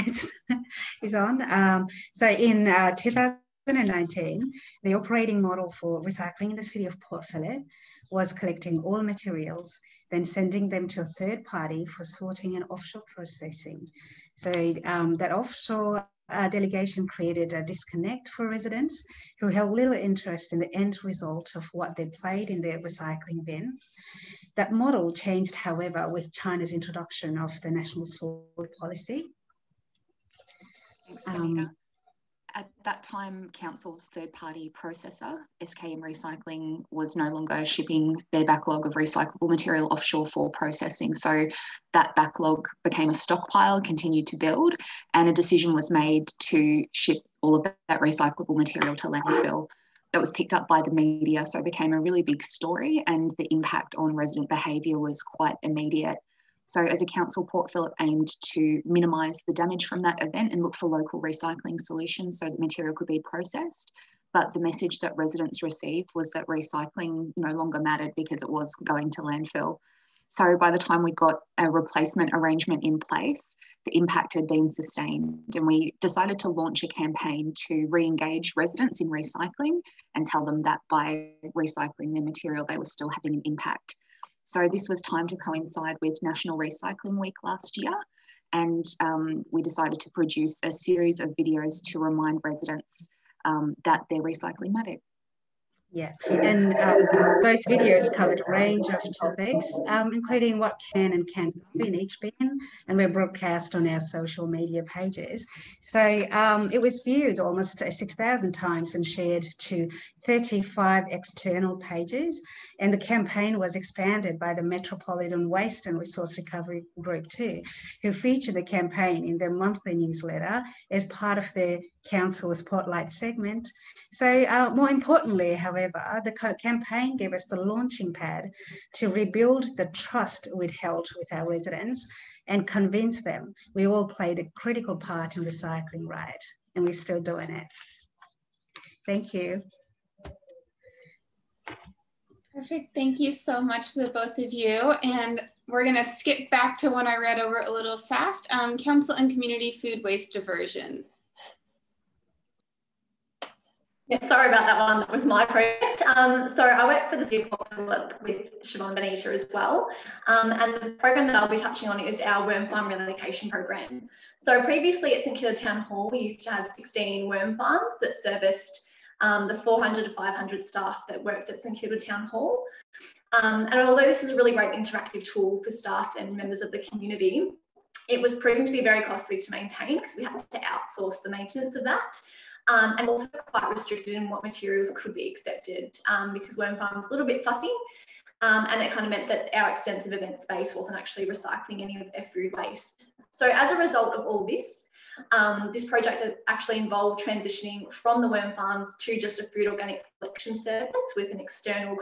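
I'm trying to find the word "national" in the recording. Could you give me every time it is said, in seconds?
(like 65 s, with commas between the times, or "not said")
27 s, 86 s.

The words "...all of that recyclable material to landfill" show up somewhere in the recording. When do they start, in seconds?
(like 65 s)
47 s.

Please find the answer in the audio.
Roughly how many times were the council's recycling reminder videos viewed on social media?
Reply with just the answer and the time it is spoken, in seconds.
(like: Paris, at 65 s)
6,000, at 107 s.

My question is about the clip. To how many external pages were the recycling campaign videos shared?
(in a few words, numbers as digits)
35.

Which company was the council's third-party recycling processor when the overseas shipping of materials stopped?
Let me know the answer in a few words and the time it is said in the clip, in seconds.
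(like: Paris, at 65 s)
SKM Recycling, at 35 s.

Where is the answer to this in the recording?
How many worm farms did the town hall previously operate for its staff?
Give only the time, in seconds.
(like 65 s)
166 s.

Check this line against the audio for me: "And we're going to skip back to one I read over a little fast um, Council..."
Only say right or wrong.
right.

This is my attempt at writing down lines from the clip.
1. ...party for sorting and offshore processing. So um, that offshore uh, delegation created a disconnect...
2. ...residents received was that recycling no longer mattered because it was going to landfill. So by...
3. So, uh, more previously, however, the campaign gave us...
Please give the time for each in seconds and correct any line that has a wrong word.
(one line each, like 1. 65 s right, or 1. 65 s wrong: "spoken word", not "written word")
1. 11 s right
2. 65 s right
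3. 124 s wrong: "importantly", not "previously".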